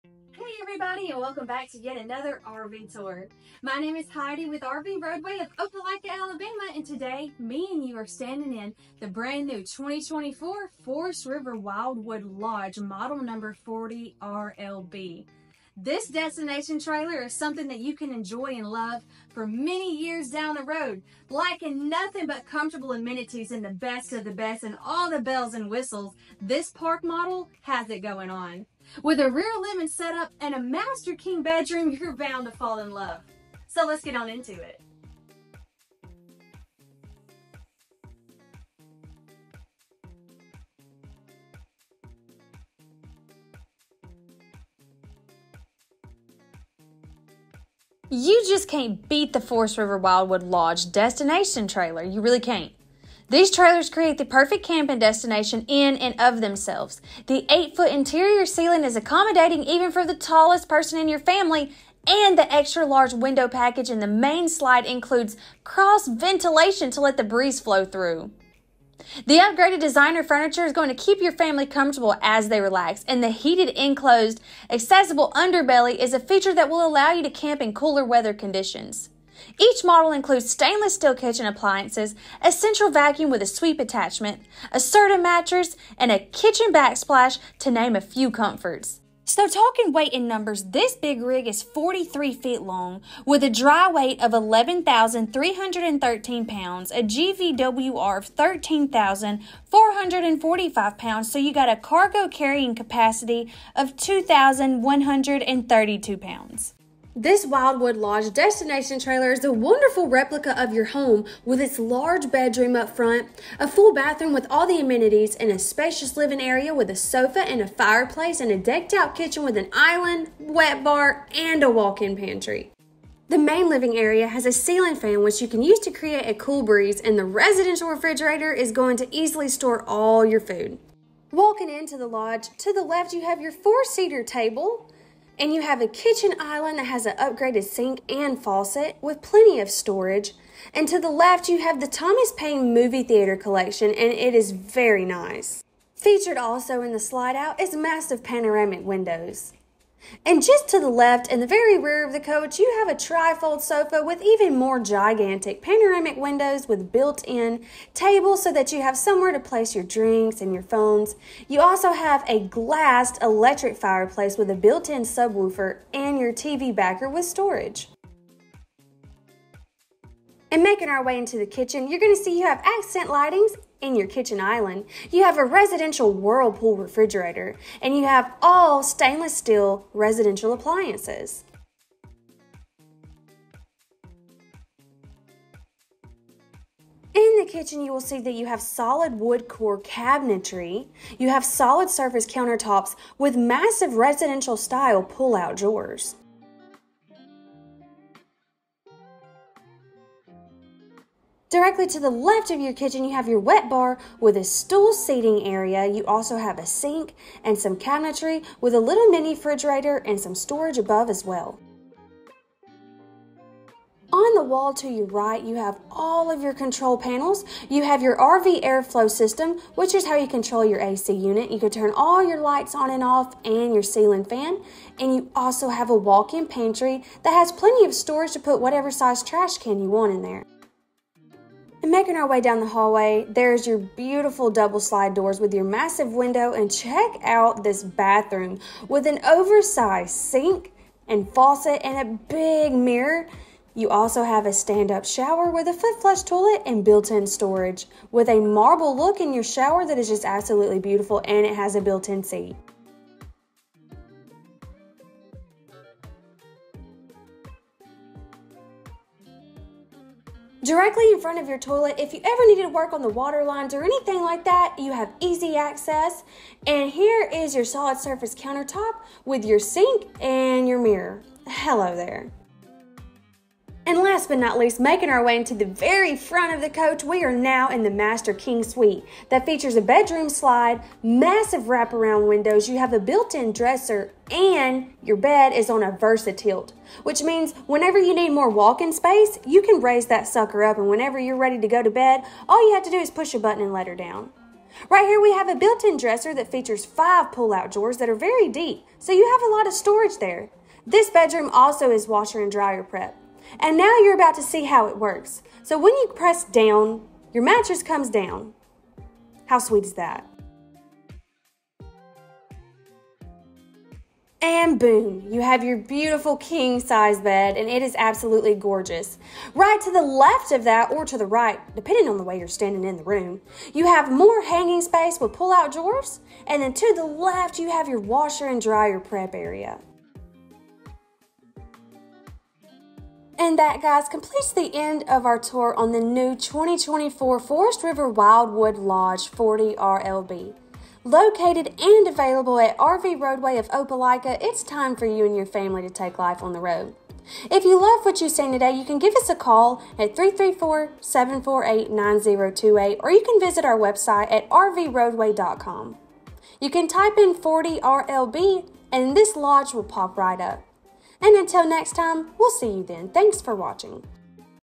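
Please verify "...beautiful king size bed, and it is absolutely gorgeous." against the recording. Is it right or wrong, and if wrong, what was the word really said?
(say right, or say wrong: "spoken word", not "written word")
right.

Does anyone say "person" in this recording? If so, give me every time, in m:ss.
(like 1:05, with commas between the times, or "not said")
1:00.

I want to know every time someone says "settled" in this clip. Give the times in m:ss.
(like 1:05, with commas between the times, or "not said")
not said.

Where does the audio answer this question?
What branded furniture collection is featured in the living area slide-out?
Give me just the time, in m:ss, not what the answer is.
2:21.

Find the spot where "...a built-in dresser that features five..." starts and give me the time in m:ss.
4:55.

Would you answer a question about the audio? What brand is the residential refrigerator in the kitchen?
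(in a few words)
Whirlpool.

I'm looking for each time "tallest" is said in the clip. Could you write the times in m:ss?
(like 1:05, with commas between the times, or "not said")
1:00.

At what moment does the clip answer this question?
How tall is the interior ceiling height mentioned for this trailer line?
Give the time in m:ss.
0:57.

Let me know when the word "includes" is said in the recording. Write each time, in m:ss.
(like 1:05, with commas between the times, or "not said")
1:04, 1:20.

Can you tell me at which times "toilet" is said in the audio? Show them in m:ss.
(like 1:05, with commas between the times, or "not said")
4:06, 4:21.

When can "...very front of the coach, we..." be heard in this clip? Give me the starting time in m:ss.
4:35.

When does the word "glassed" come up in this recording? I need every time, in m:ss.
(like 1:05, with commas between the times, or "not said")
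2:42.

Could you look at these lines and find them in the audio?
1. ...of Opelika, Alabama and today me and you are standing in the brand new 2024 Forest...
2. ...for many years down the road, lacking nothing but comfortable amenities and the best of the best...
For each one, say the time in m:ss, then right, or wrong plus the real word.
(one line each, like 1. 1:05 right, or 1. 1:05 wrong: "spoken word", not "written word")
1. 0:05 right
2. 0:19 right.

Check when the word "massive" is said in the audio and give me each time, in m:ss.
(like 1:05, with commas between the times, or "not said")
2:27, 3:13, 3:55, 4:41.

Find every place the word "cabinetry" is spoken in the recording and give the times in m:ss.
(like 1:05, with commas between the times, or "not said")
3:09, 3:27.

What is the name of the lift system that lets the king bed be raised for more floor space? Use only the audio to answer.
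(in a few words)
Versa tilt.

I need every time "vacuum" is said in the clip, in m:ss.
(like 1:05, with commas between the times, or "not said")
1:22.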